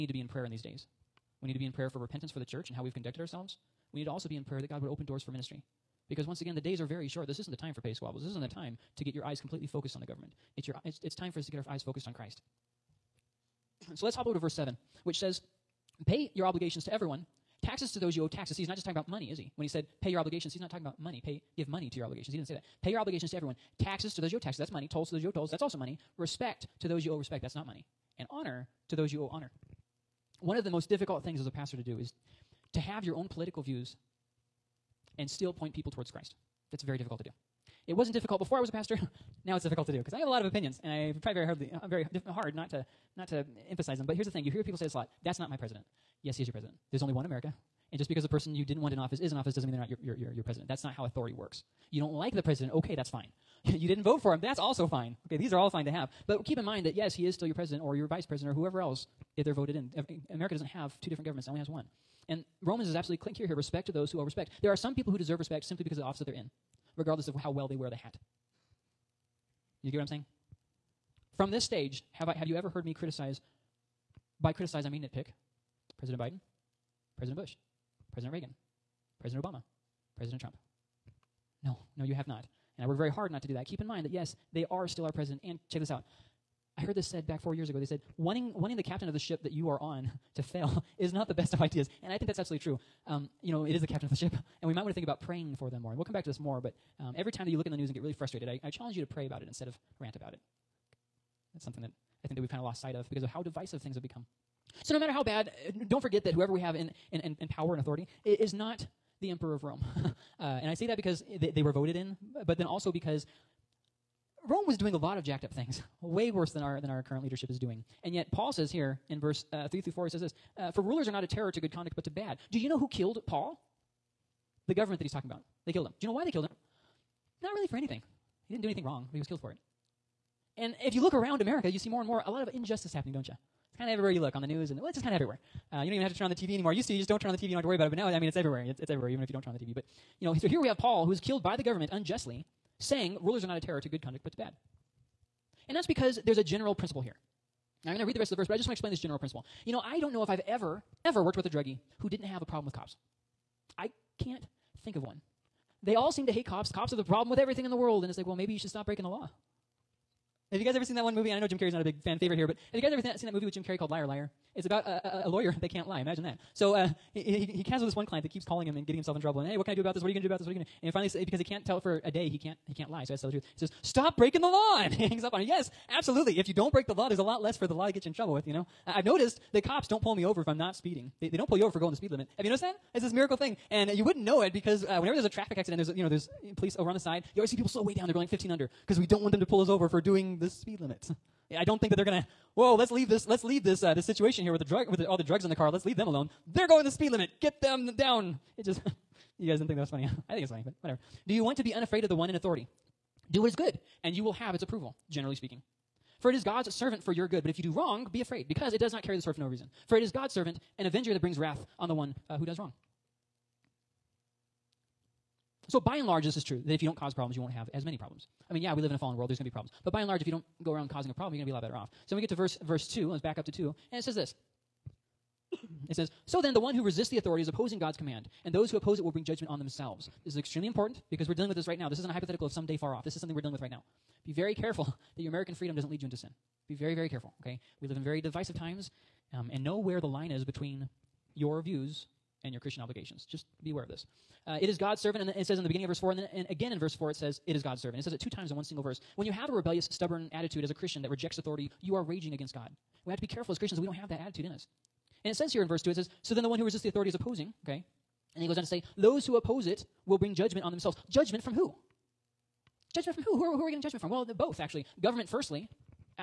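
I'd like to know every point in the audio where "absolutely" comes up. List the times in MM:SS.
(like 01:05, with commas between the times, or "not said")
01:02, 01:32, 02:55.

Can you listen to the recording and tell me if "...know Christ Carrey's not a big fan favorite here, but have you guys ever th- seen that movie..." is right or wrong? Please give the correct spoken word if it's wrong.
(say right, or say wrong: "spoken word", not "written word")
wrong: "Jim", not "Christ".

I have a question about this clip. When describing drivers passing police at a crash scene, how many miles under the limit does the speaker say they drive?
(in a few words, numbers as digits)
15.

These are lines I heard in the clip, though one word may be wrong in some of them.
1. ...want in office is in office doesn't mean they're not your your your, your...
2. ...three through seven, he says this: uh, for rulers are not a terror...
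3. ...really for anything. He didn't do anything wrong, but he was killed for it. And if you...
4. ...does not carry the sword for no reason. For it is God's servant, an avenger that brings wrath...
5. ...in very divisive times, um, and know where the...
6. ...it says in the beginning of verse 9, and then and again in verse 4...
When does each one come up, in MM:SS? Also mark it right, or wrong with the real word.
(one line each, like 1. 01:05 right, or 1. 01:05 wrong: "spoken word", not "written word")
1. 00:48 right
2. 01:59 wrong: "four", not "seven"
3. 02:07 right
4. 03:28 right
5. 03:57 right
6. 04:05 wrong: "4", not "9".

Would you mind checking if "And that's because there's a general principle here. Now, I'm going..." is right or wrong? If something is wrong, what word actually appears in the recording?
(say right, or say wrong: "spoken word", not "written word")
right.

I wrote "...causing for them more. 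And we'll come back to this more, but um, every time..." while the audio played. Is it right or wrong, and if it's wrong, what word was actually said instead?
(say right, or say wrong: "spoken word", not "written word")
wrong: "praying", not "causing".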